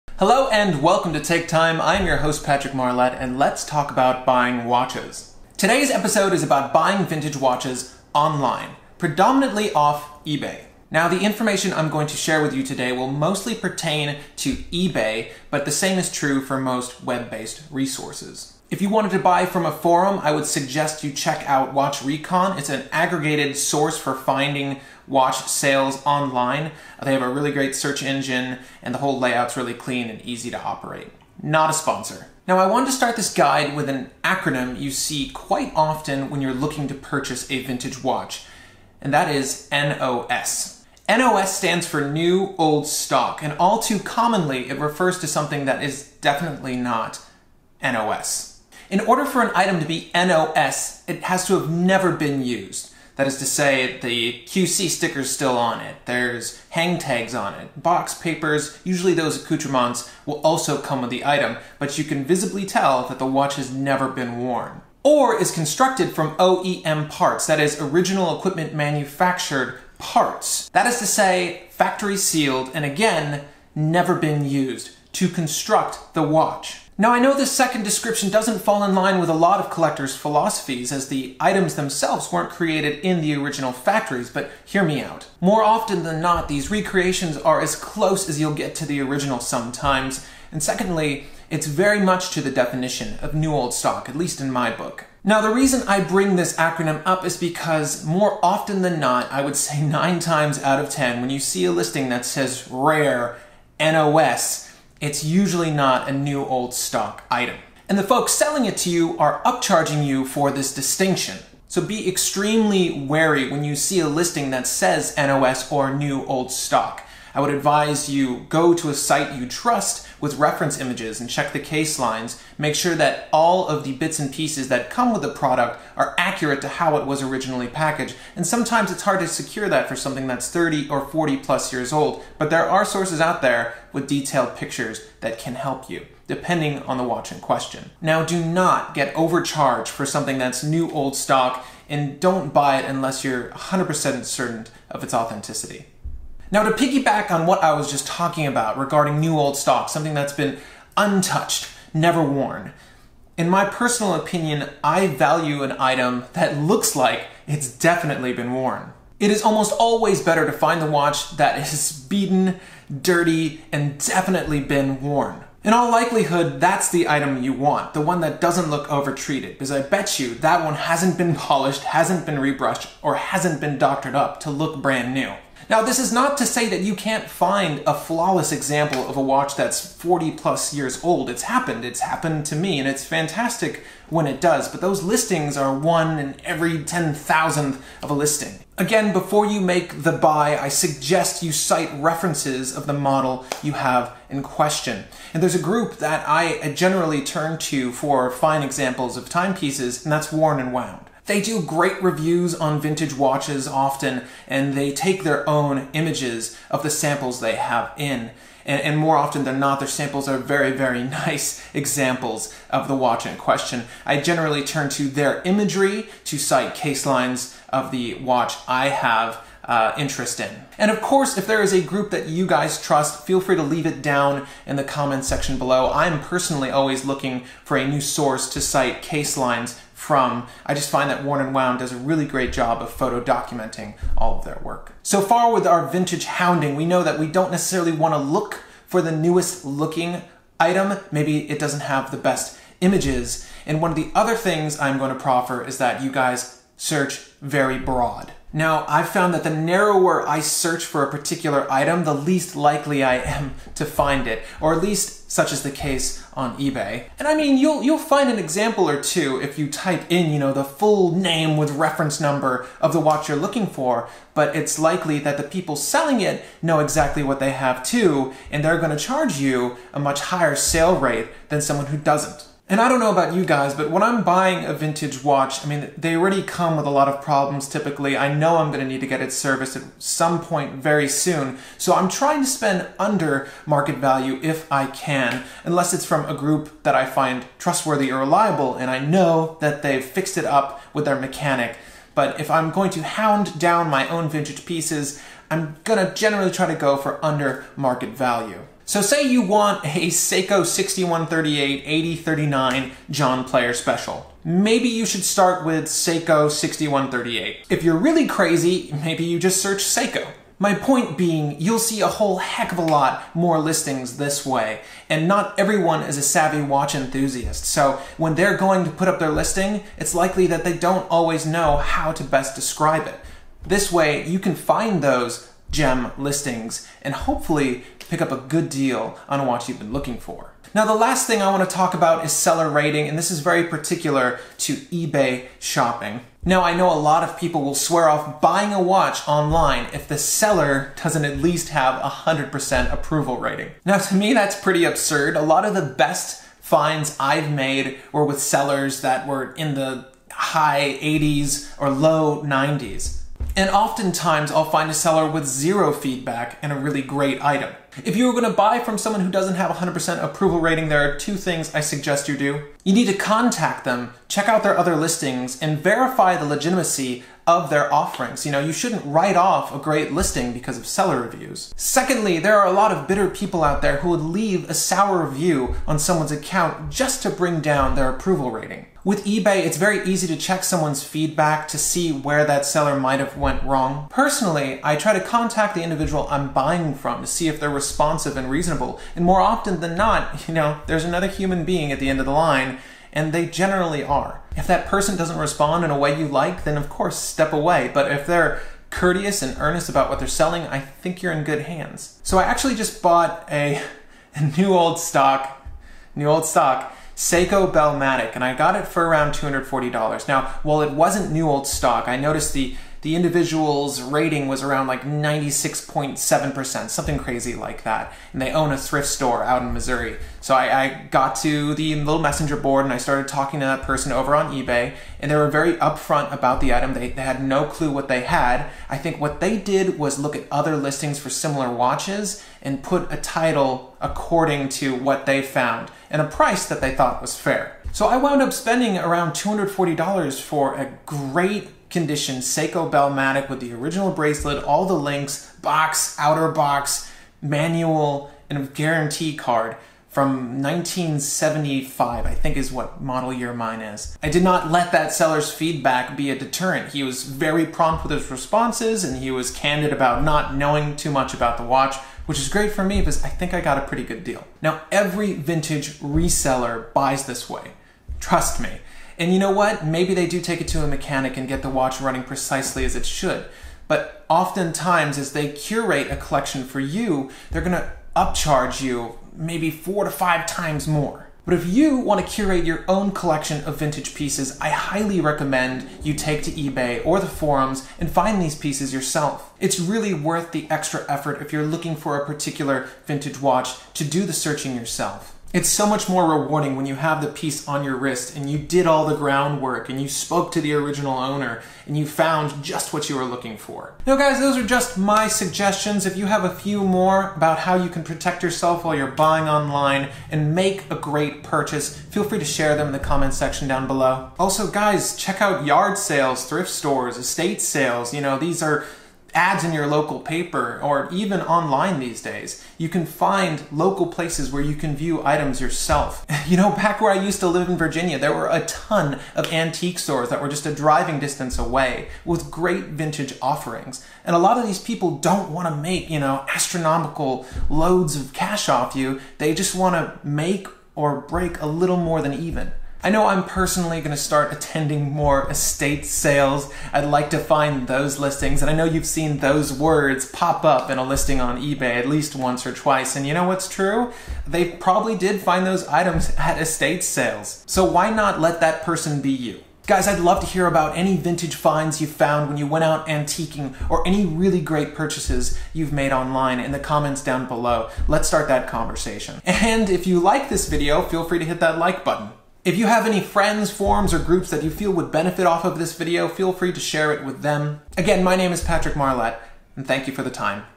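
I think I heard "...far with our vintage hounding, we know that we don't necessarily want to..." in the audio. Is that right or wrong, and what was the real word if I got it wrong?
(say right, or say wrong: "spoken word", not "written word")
right.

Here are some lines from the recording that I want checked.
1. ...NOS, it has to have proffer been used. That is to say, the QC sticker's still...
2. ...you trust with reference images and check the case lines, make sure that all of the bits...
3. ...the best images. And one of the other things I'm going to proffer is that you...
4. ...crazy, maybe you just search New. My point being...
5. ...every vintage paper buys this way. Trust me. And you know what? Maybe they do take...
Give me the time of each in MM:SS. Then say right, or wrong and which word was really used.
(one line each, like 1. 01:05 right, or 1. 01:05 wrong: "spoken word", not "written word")
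1. 00:50 wrong: "never", not "proffer"
2. 01:59 right
3. 04:02 right
4. 05:08 wrong: "Seiko", not "New"
5. 07:44 wrong: "reseller", not "paper".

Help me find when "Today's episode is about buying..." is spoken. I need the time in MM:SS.
00:05.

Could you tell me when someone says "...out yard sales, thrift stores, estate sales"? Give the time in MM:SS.
08:35.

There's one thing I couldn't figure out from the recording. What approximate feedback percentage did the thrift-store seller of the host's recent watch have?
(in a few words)
96.7%.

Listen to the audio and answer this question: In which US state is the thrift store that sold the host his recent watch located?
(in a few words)
Missouri.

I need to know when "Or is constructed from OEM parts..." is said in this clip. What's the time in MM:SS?
01:05.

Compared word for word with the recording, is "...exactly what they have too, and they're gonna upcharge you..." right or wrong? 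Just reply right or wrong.
wrong.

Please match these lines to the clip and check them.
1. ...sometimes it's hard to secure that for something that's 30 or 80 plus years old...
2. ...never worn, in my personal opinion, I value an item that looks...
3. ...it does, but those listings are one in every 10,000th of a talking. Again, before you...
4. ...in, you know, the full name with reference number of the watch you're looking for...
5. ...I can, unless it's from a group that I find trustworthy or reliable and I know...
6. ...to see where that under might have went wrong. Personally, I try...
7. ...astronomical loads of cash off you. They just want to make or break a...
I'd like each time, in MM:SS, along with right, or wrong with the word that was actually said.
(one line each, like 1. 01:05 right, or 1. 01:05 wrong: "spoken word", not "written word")
1. 02:08 wrong: "40", not "80"
2. 02:31 right
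3. 03:04 wrong: "listing", not "talking"
4. 04:20 right
5. 04:44 right
6. 06:21 wrong: "seller", not "under"
7. 08:56 right.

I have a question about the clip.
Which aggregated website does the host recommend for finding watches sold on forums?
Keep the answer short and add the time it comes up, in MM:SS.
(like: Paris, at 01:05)
Watch Recon, at 00:21.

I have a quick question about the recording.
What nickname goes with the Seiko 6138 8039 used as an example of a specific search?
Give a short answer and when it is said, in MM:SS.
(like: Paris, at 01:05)
John Player Special, at 05:03.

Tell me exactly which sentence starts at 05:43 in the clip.
Now to me that's pretty absurd.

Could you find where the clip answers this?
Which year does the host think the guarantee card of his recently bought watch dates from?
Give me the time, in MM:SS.
07:30.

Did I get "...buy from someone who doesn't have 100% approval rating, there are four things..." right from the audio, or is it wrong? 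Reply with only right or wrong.
wrong.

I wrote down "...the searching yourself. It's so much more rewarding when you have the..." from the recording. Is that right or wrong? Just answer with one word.
right.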